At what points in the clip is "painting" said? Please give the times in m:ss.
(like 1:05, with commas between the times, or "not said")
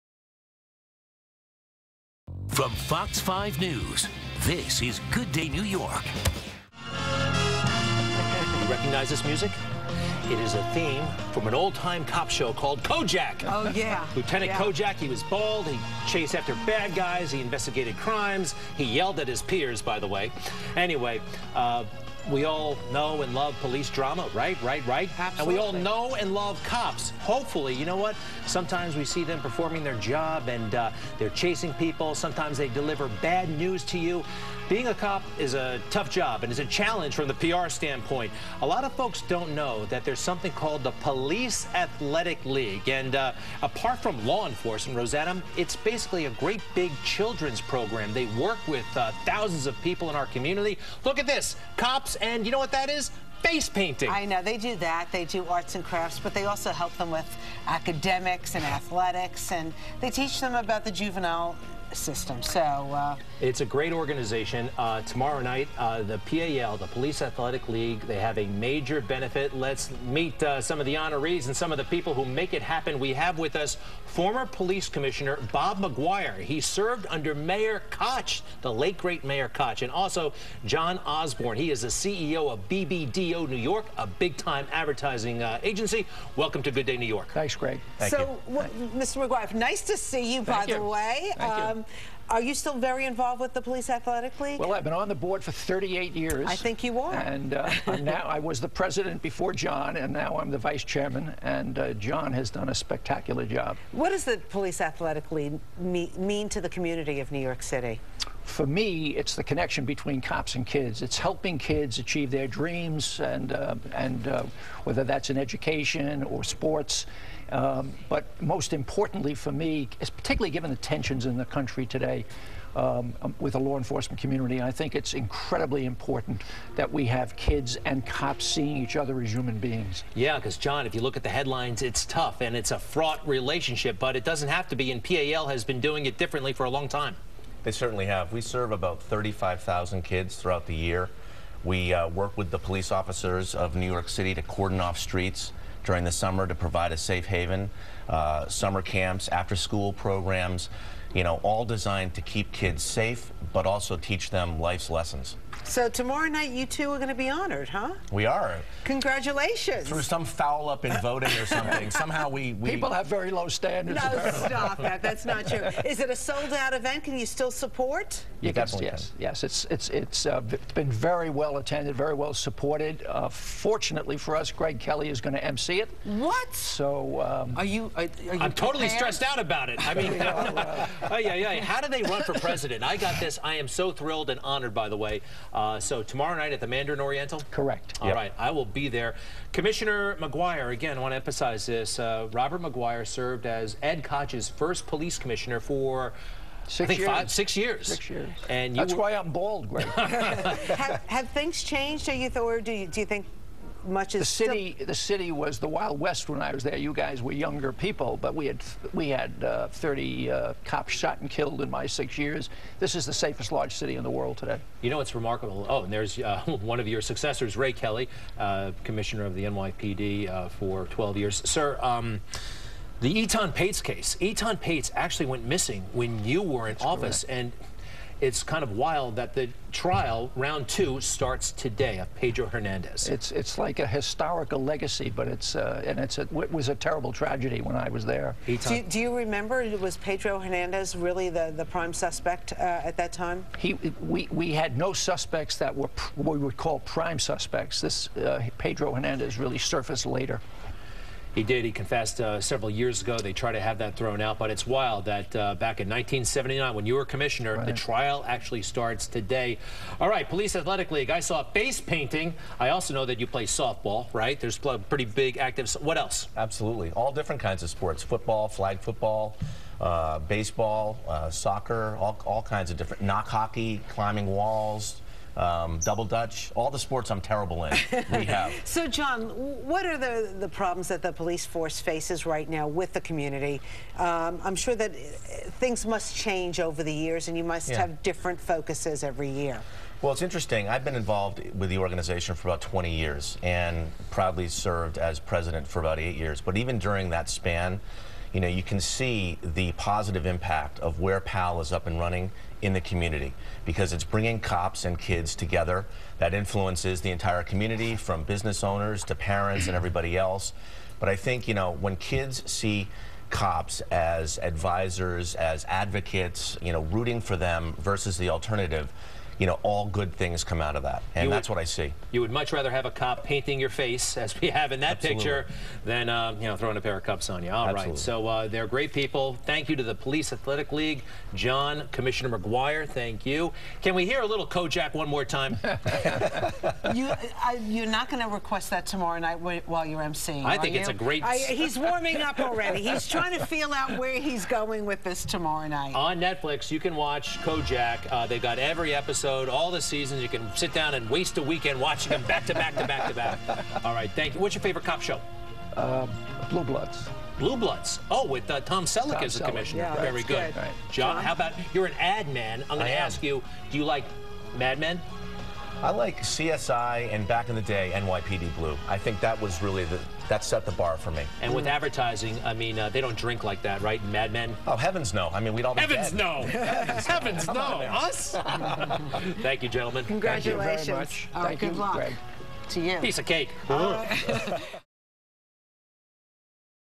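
0:53, 4:21, 5:23.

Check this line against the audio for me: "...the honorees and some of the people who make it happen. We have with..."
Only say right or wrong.
right.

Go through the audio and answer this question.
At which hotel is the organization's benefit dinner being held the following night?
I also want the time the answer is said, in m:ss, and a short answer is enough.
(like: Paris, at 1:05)
Mandarin Oriental, at 3:06.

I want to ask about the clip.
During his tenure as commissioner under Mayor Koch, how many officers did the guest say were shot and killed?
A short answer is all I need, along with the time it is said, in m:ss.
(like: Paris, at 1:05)
30, at 3:29.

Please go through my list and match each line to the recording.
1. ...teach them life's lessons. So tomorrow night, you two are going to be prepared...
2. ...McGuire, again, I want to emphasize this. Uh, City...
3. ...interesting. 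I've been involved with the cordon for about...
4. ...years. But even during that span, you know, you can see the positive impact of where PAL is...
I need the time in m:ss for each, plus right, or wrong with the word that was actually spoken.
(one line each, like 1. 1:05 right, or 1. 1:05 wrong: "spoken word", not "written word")
1. 2:33 wrong: "honored", not "prepared"
2. 3:10 wrong: "Robert", not "City"
3. 4:50 wrong: "organization", not "cordon"
4. 4:56 right.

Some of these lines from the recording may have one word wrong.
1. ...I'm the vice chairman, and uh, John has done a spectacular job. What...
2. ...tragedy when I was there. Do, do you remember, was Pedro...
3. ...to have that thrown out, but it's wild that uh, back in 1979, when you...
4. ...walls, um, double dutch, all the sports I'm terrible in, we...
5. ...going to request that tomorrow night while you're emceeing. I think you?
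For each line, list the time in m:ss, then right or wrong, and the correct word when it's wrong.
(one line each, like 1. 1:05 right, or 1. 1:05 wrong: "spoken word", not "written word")
1. 1:40 right
2. 3:57 right
3. 4:13 right
4. 4:34 right
5. 5:38 right.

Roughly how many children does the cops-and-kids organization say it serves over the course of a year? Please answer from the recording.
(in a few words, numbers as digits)
35,000.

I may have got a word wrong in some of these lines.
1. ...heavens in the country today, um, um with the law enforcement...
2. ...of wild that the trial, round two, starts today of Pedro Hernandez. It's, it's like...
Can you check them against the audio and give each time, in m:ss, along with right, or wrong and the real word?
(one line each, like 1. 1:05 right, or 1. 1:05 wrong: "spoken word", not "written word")
1. 2:00 wrong: "tensions", not "heavens"
2. 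3:48 right.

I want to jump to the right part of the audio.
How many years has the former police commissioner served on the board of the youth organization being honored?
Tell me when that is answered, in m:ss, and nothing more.
1:35.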